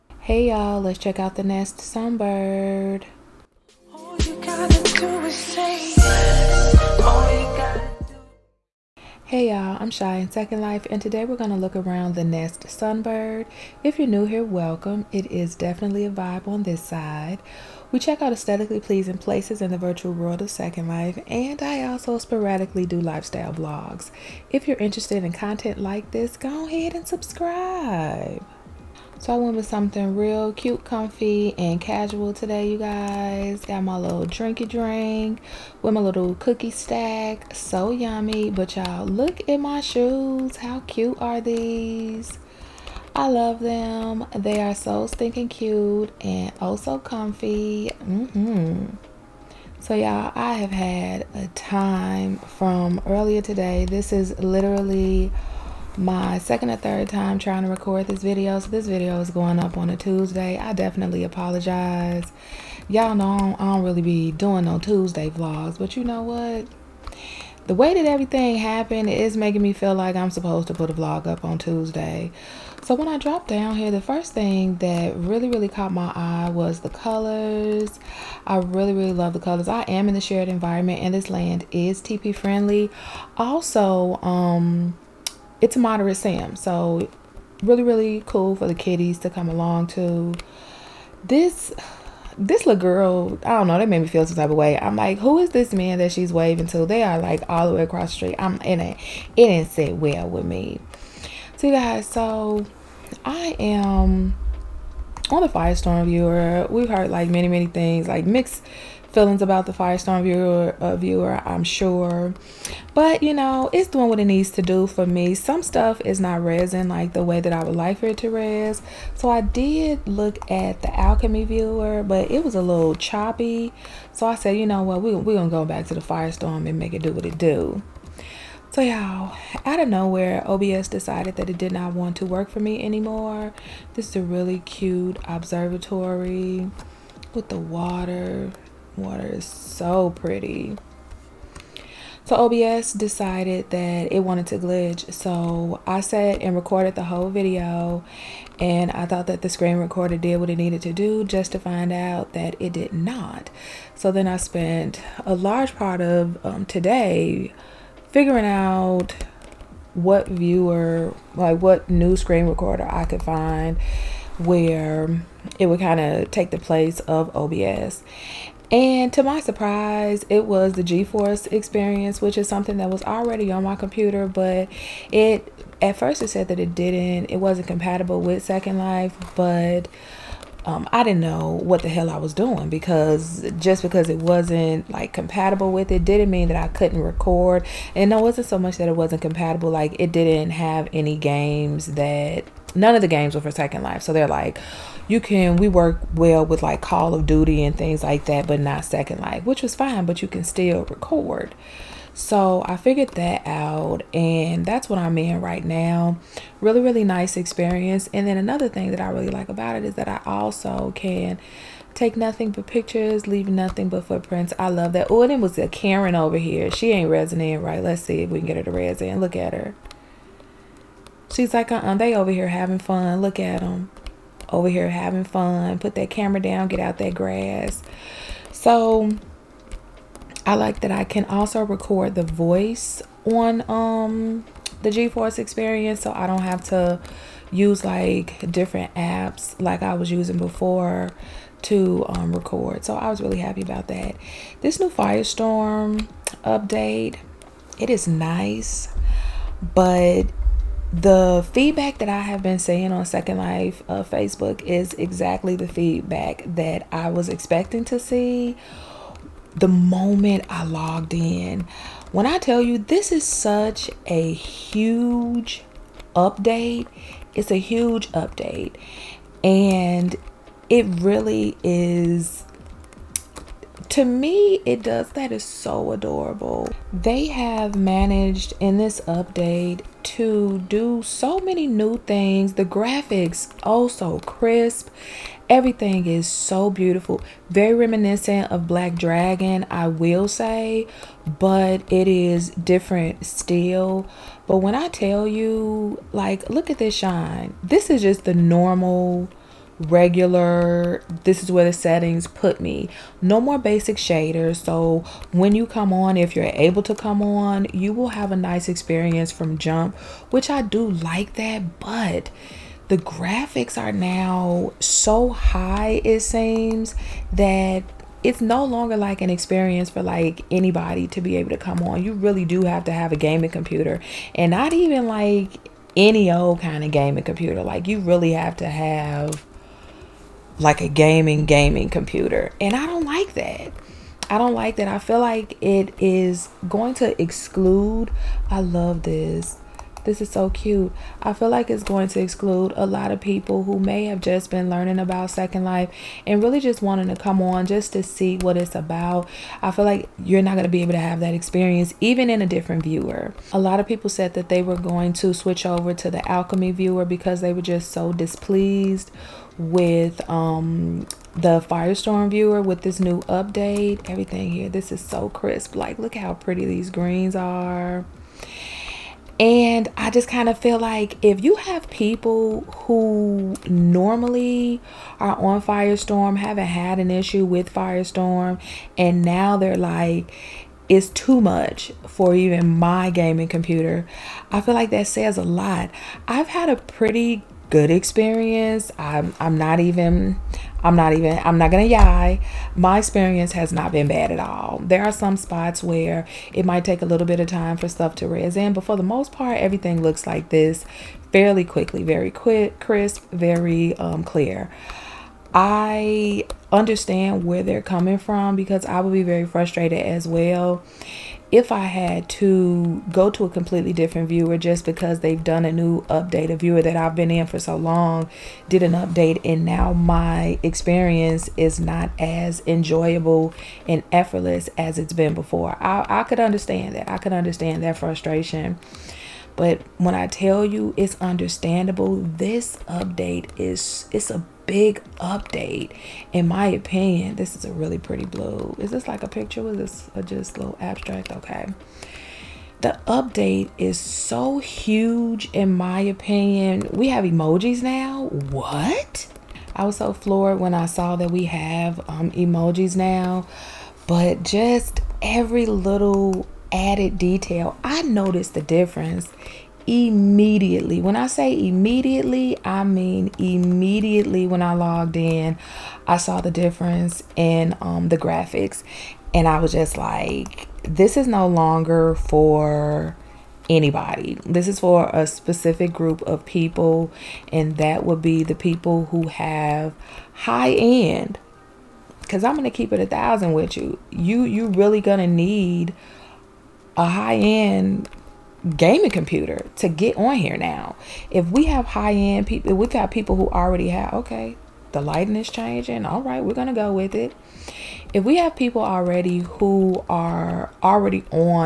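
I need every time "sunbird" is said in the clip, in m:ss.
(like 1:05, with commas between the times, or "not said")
0:01, 0:12.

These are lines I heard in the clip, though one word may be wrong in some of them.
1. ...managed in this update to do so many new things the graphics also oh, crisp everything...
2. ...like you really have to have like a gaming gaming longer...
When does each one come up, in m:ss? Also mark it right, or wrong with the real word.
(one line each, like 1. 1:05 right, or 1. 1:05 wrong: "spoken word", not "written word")
1. 4:37 right
2. 5:27 wrong: "computer", not "longer".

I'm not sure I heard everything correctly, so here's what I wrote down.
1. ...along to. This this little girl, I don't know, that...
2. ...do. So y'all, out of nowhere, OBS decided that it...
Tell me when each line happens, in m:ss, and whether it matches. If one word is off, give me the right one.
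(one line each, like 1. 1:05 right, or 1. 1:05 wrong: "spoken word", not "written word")
1. 1:29 right
2. 2:07 right.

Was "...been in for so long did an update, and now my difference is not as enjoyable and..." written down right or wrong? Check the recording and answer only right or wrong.
wrong.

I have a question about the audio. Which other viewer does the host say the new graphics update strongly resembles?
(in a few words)
Black Dragon.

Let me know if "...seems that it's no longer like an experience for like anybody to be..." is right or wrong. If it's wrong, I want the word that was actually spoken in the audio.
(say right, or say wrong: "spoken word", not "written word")
right.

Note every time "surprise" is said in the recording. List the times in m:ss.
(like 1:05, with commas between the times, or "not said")
2:49.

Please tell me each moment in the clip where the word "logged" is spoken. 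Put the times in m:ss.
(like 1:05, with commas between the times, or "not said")
4:20, 7:44.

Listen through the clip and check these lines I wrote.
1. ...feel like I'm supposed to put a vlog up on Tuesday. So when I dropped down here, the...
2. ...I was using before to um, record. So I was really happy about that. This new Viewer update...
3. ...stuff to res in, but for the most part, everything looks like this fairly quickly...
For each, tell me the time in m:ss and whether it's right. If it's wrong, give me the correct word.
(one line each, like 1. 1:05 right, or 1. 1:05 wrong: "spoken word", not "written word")
1. 1:09 right
2. 3:59 wrong: "Firestorm", not "Viewer"
3. 6:37 right.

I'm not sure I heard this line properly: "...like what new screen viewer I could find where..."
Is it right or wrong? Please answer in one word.
wrong.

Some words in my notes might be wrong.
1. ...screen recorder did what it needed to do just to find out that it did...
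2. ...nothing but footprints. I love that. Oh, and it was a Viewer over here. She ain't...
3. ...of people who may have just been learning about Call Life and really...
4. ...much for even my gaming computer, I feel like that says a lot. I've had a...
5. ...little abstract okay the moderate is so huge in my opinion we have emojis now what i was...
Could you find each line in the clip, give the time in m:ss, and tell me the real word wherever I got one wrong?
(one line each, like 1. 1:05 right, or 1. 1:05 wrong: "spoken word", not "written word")
1. 2:29 right
2. 3:33 wrong: "Karen", not "Viewer"
3. 5:43 wrong: "Second", not "Call"
4. 6:21 right
5. 7:20 wrong: "update", not "moderate".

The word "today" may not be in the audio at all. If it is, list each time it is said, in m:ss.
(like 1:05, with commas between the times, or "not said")
0:11, 0:32, 0:53, 2:36.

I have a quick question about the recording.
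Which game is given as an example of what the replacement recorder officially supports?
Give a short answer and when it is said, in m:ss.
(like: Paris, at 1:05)
Call of Duty, at 3:16.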